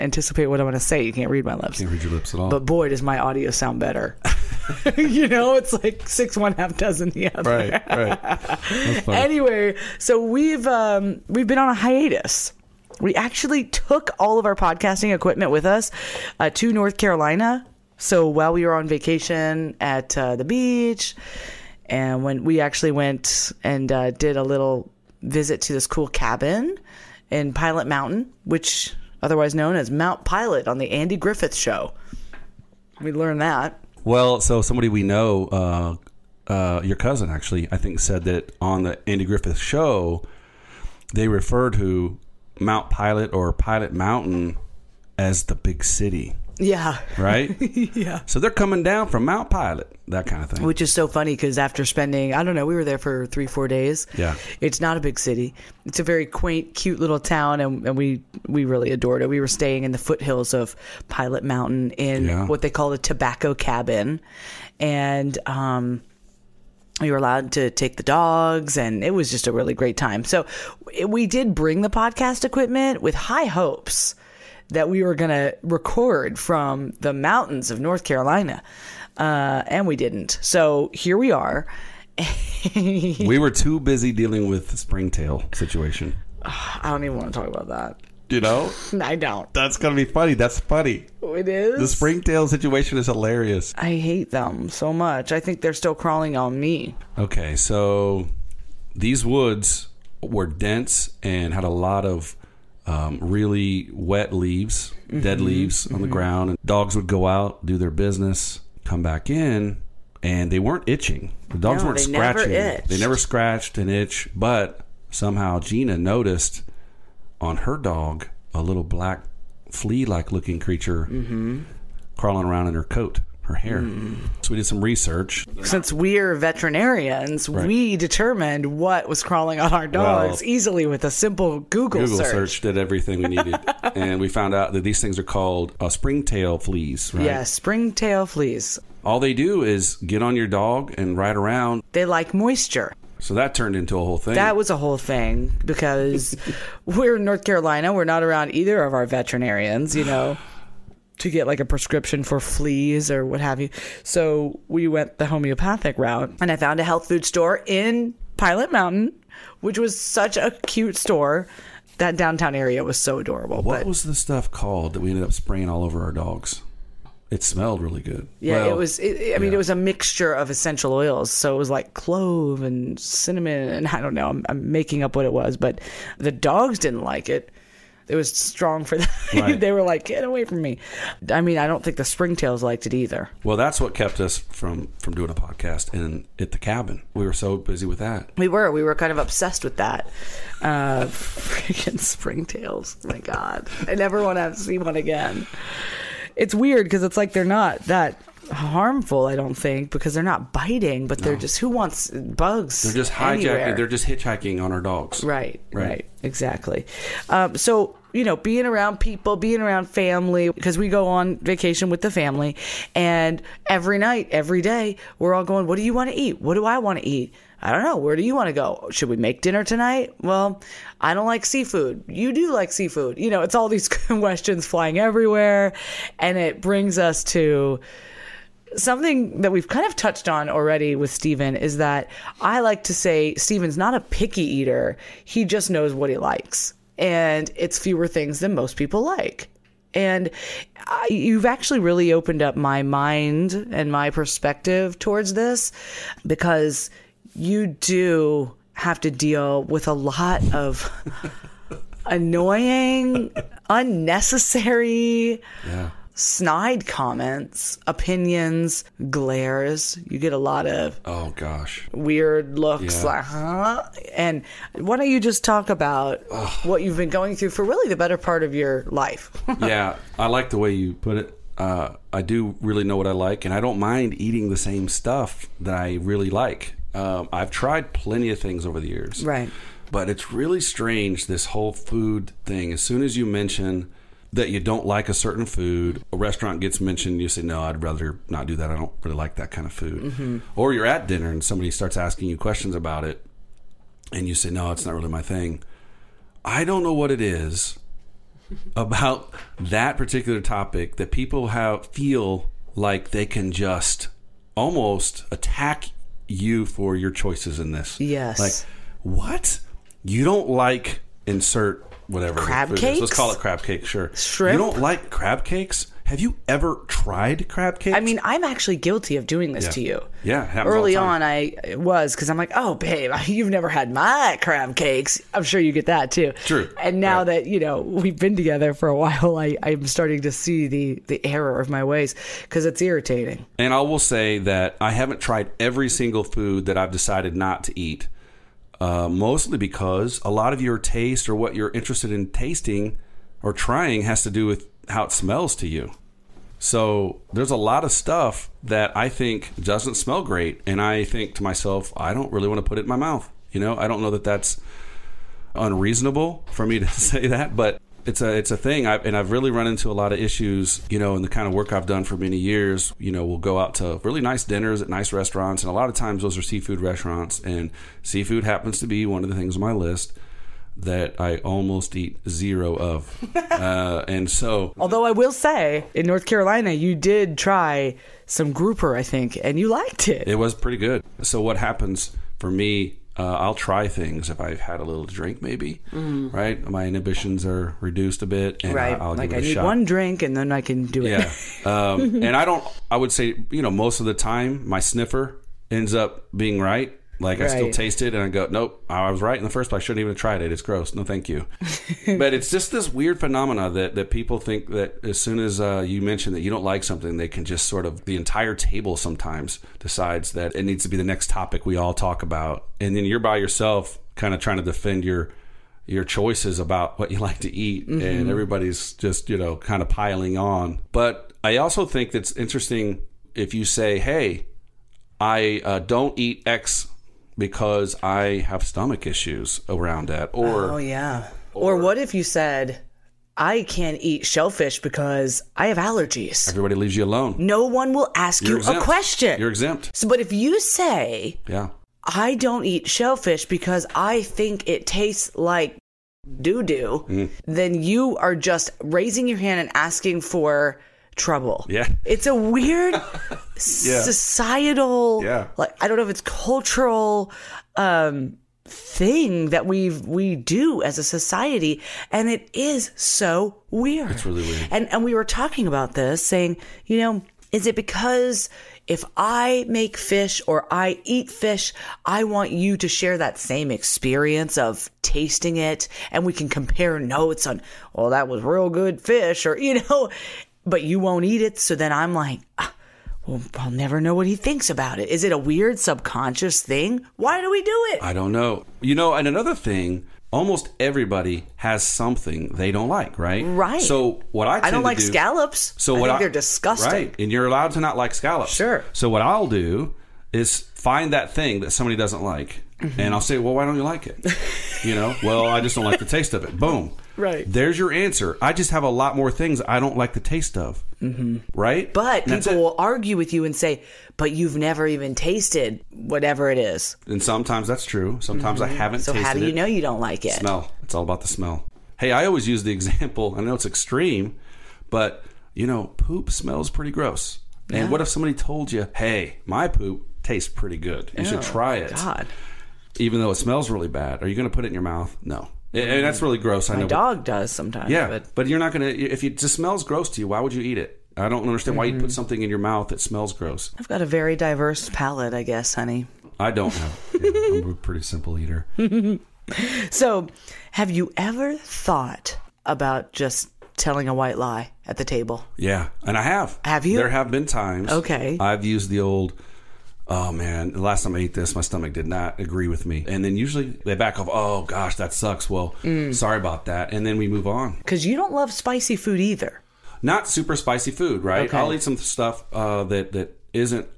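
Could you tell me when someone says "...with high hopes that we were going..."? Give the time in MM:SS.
01:13.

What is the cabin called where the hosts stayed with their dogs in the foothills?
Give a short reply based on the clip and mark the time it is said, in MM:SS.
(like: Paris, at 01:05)
Tobacco cabin, at 01:02.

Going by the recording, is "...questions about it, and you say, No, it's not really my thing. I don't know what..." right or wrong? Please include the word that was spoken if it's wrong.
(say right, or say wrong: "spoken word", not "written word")
right.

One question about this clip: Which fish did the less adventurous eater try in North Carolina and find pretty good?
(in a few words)
Grouper.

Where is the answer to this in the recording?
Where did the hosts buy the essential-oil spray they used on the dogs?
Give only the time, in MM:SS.
02:36.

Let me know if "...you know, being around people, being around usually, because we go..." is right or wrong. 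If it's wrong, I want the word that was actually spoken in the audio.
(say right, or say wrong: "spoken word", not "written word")
wrong: "family", not "usually".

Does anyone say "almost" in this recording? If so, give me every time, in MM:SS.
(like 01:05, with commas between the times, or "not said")
05:04, 06:11, 08:10.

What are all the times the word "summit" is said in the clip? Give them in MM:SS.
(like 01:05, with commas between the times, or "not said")
not said.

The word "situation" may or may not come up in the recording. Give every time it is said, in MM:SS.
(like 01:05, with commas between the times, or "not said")
01:25, 01:32.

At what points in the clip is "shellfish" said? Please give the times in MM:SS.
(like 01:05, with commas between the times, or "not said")
07:14, 07:22.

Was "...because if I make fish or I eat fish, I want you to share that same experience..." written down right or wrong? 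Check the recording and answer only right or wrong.
right.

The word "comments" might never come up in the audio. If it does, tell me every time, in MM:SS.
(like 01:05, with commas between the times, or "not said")
04:16.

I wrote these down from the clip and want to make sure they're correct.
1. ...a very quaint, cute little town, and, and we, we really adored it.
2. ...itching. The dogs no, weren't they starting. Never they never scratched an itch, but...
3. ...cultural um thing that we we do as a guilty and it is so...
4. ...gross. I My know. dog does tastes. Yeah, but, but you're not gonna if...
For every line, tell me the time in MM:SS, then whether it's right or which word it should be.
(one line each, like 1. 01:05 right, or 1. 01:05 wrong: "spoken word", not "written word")
1. 00:55 right
2. 01:50 wrong: "scratching", not "starting"
3. 07:36 wrong: "society", not "guilty"
4. 08:56 wrong: "sometimes", not "tastes".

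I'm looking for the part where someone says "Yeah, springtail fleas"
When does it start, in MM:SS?
02:17.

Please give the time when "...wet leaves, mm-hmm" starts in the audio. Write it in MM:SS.
01:43.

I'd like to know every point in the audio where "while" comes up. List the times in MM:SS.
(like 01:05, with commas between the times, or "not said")
00:18, 05:28.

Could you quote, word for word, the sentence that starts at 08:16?
Right, and you're allowed to not like scallops.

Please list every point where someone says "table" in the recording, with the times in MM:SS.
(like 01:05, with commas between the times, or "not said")
06:48, 09:15.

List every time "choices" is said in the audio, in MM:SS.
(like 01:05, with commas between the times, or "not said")
05:07, 06:56.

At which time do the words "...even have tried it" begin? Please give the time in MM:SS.
06:40.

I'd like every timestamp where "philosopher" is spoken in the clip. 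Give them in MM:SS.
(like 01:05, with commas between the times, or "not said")
not said.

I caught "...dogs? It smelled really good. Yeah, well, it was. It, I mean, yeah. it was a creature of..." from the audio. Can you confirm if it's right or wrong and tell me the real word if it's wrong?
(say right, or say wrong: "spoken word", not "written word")
wrong: "mixture", not "creature".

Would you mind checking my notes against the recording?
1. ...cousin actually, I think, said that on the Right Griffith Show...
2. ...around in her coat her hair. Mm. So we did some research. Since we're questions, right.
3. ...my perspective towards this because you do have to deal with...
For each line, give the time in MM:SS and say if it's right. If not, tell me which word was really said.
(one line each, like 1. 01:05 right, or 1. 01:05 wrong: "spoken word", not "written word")
1. 00:36 wrong: "Andy", not "Right"
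2. 02:02 wrong: "veterinarians", not "questions"
3. 04:03 right.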